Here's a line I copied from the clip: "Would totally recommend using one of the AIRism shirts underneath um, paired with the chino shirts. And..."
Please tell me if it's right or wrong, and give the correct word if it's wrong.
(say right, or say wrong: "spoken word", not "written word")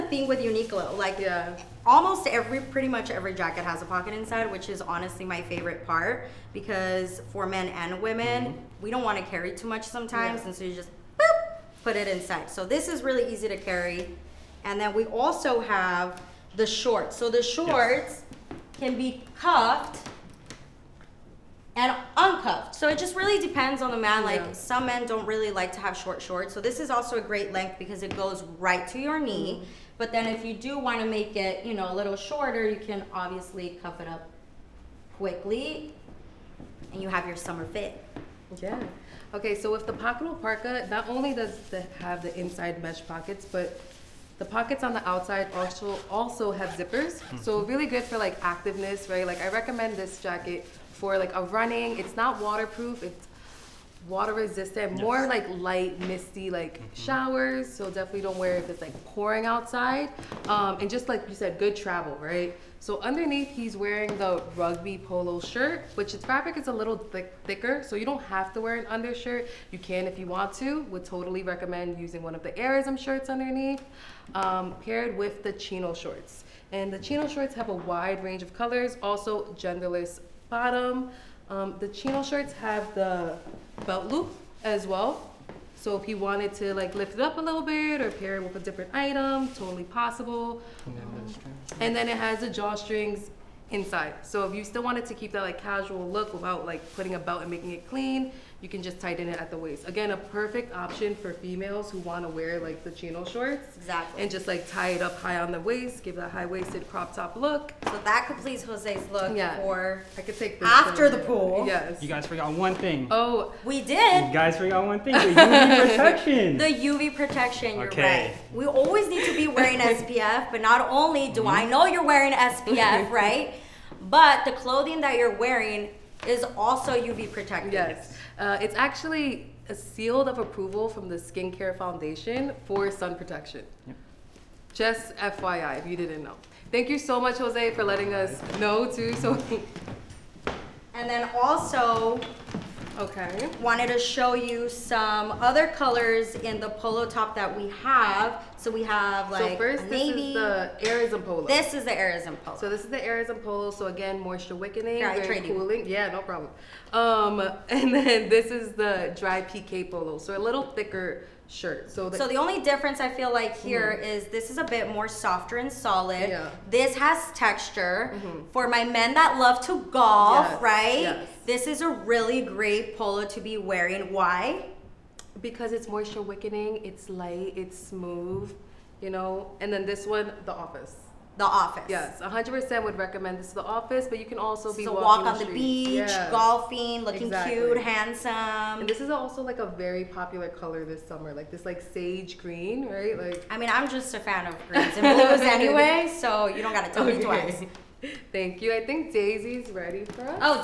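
wrong: "shorts", not "shirts".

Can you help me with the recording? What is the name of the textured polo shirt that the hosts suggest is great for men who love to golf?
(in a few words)
dry PK polo.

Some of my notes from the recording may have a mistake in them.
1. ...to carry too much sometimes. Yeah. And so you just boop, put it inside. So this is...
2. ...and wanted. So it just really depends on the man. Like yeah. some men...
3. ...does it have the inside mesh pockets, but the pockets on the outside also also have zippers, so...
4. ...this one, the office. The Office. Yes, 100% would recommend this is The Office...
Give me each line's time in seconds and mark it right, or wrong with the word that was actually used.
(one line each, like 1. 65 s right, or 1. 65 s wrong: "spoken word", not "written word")
1. 9 s right
2. 21 s wrong: "uncuffed", not "wanted"
3. 41 s right
4. 179 s right.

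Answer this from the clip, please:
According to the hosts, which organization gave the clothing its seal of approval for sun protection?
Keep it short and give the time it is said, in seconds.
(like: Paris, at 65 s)
Skincare Foundation, at 131 s.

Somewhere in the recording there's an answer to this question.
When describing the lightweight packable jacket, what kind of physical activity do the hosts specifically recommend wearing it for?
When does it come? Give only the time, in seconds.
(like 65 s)
51 s.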